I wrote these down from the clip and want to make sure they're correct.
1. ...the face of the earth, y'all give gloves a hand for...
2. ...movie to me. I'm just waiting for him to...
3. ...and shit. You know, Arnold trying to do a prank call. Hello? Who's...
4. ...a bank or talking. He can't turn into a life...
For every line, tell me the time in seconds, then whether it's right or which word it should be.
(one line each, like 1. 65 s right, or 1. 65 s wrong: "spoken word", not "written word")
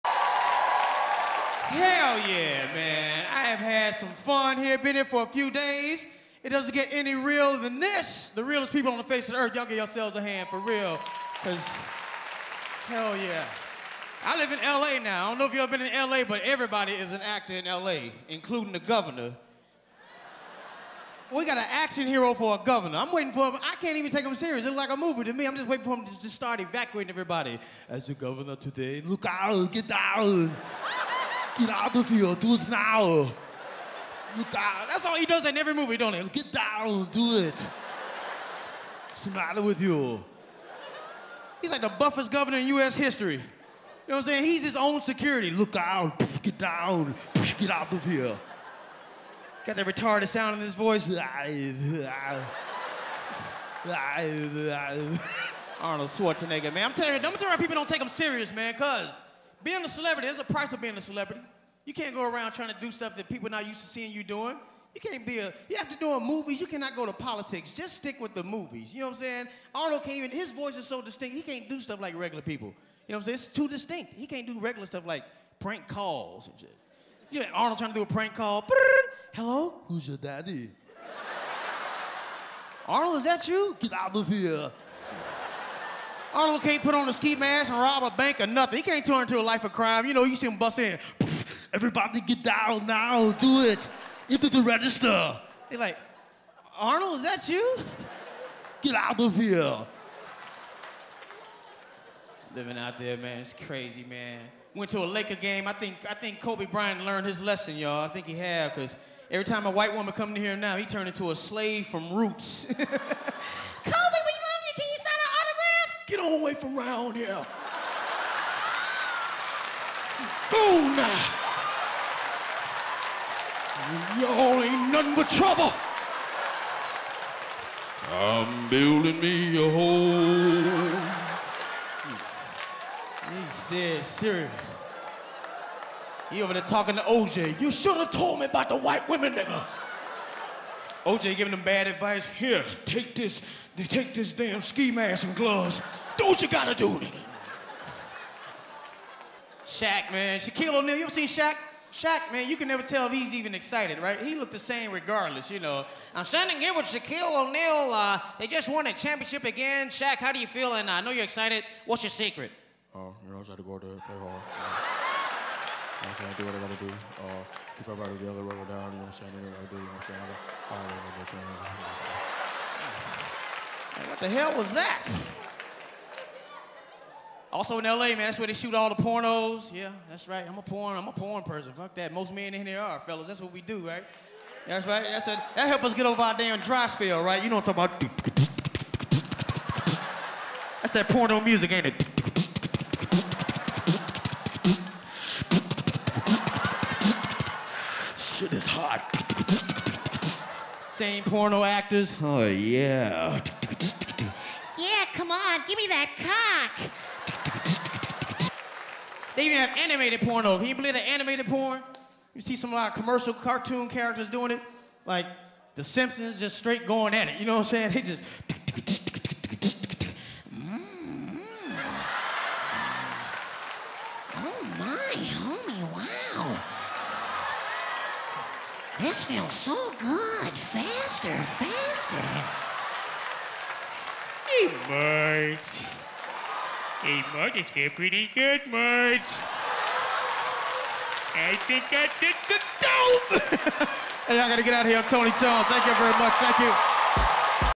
1. 8 s wrong: "yourselves", not "gloves"
2. 24 s right
3. 76 s right
4. 88 s wrong: "nothing", not "talking".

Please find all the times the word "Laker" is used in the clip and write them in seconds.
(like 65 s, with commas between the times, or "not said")
105 s.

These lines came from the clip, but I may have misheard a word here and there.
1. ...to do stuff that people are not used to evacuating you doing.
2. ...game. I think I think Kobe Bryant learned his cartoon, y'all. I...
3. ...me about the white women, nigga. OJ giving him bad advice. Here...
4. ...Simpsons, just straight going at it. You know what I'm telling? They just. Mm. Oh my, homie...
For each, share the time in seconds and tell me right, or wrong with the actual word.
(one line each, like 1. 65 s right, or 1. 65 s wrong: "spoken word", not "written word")
1. 62 s wrong: "seeing", not "evacuating"
2. 105 s wrong: "lesson", not "cartoon"
3. 138 s right
4. 215 s wrong: "saying", not "telling".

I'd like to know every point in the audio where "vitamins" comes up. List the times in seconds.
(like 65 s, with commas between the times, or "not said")
not said.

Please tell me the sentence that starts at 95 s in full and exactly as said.
They're like, Arnold, is that you?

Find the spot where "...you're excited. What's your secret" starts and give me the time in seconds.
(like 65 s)
161 s.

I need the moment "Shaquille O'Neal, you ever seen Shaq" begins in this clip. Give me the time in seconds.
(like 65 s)
150 s.